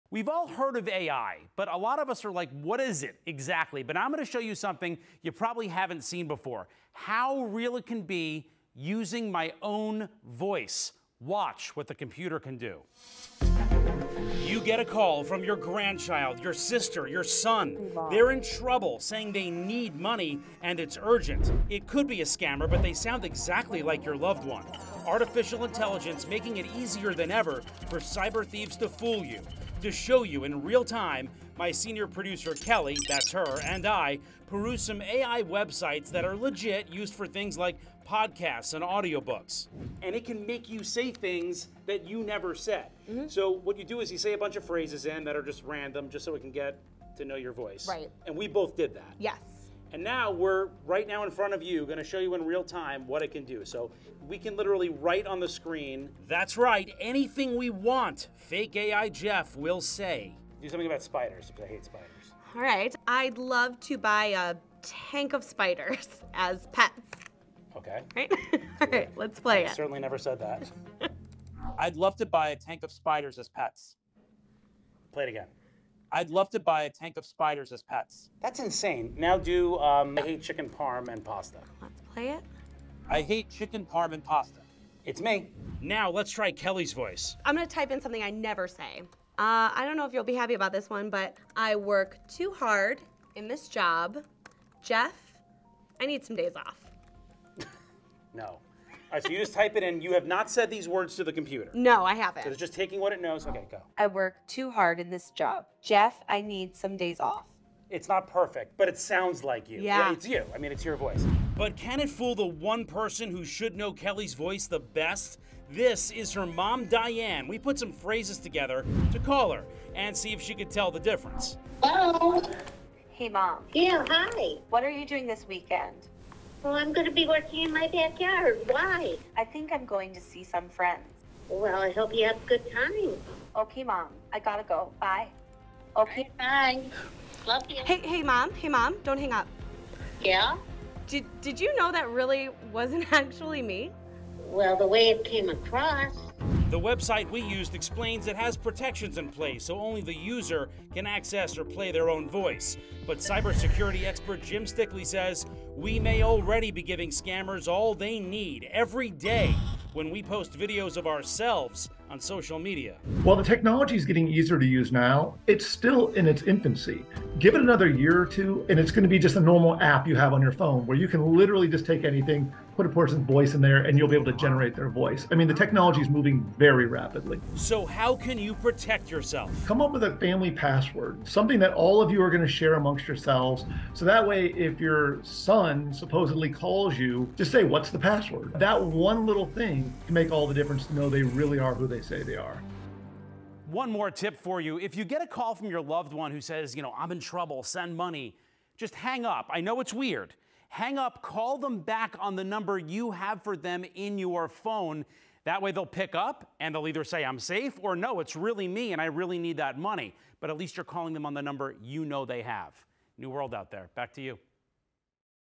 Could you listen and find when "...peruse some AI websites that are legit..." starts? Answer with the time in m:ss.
0:34.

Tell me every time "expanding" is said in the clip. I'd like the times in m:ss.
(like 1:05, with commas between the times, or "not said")
not said.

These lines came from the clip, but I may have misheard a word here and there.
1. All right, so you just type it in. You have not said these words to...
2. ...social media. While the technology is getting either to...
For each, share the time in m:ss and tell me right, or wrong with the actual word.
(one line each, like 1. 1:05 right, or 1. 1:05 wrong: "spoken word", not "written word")
1. 1:39 right
2. 2:42 wrong: "easier", not "either".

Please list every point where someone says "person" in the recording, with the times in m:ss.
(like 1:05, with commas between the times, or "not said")
1:52, 2:52.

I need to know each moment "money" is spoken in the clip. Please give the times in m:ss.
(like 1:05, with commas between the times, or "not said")
0:19, 3:17, 3:29.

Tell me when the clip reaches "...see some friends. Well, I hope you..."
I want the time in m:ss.
2:10.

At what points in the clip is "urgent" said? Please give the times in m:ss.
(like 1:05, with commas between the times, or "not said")
0:21.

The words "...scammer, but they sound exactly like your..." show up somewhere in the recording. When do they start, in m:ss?
0:22.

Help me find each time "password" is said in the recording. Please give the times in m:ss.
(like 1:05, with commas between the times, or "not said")
3:00, 3:07.